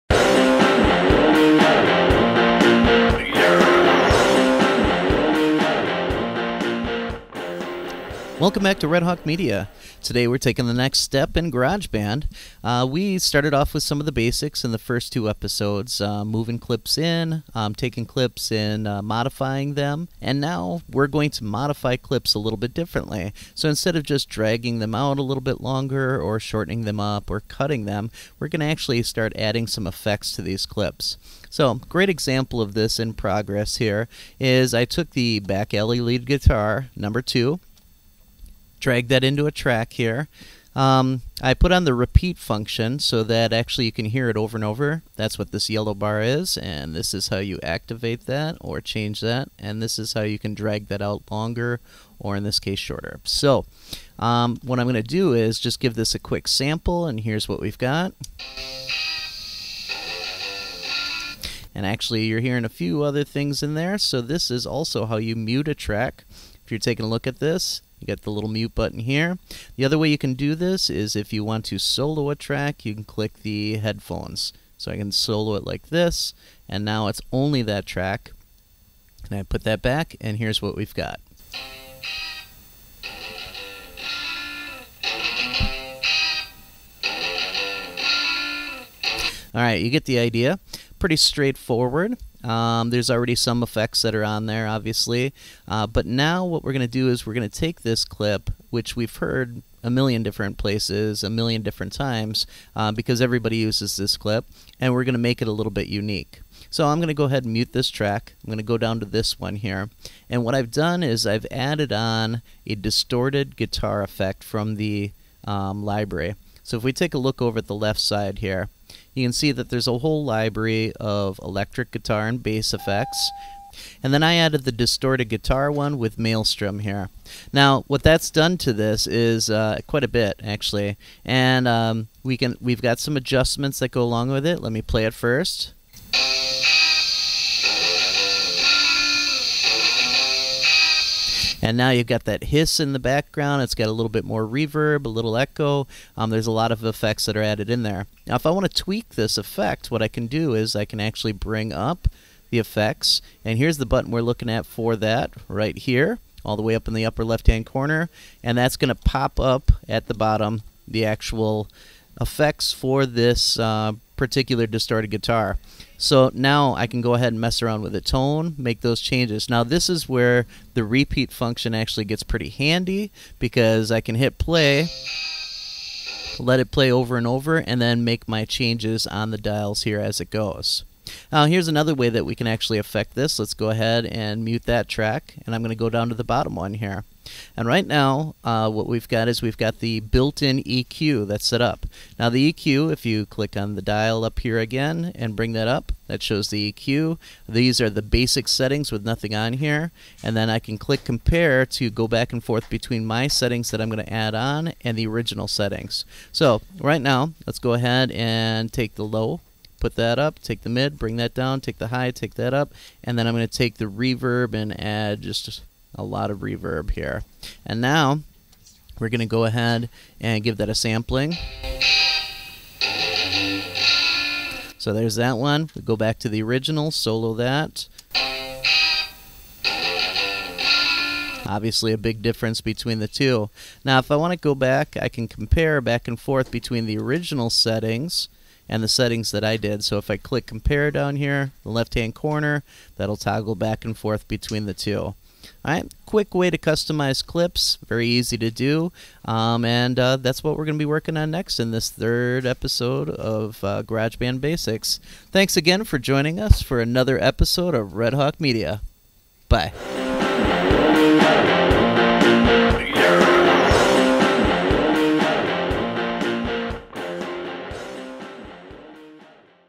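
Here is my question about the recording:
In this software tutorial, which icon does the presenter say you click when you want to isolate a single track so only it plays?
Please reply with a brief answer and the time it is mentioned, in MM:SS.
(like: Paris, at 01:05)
Headphones, at 01:13.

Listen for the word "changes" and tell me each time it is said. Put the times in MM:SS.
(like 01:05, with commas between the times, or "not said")
00:48, 02:49, 02:58.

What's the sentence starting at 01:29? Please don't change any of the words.
All right, you get the idea.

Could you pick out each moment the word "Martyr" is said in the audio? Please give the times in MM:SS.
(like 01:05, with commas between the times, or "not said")
not said.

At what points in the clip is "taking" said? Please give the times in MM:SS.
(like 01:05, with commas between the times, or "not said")
00:10, 00:17, 01:06.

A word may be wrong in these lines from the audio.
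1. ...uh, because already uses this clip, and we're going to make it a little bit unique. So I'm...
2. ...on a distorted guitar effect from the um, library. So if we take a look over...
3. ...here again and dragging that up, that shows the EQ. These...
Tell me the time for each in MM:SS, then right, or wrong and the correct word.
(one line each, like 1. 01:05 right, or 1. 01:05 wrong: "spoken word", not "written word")
1. 01:42 wrong: "everybody", not "already"
2. 01:51 right
3. 03:14 wrong: "bring", not "dragging".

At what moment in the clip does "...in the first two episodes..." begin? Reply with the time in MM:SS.
00:14.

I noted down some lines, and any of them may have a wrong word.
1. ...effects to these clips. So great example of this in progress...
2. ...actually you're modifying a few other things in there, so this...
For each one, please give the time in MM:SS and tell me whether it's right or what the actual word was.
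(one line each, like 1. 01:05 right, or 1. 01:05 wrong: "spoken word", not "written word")
1. 00:29 right
2. 01:01 wrong: "hearing", not "modifying".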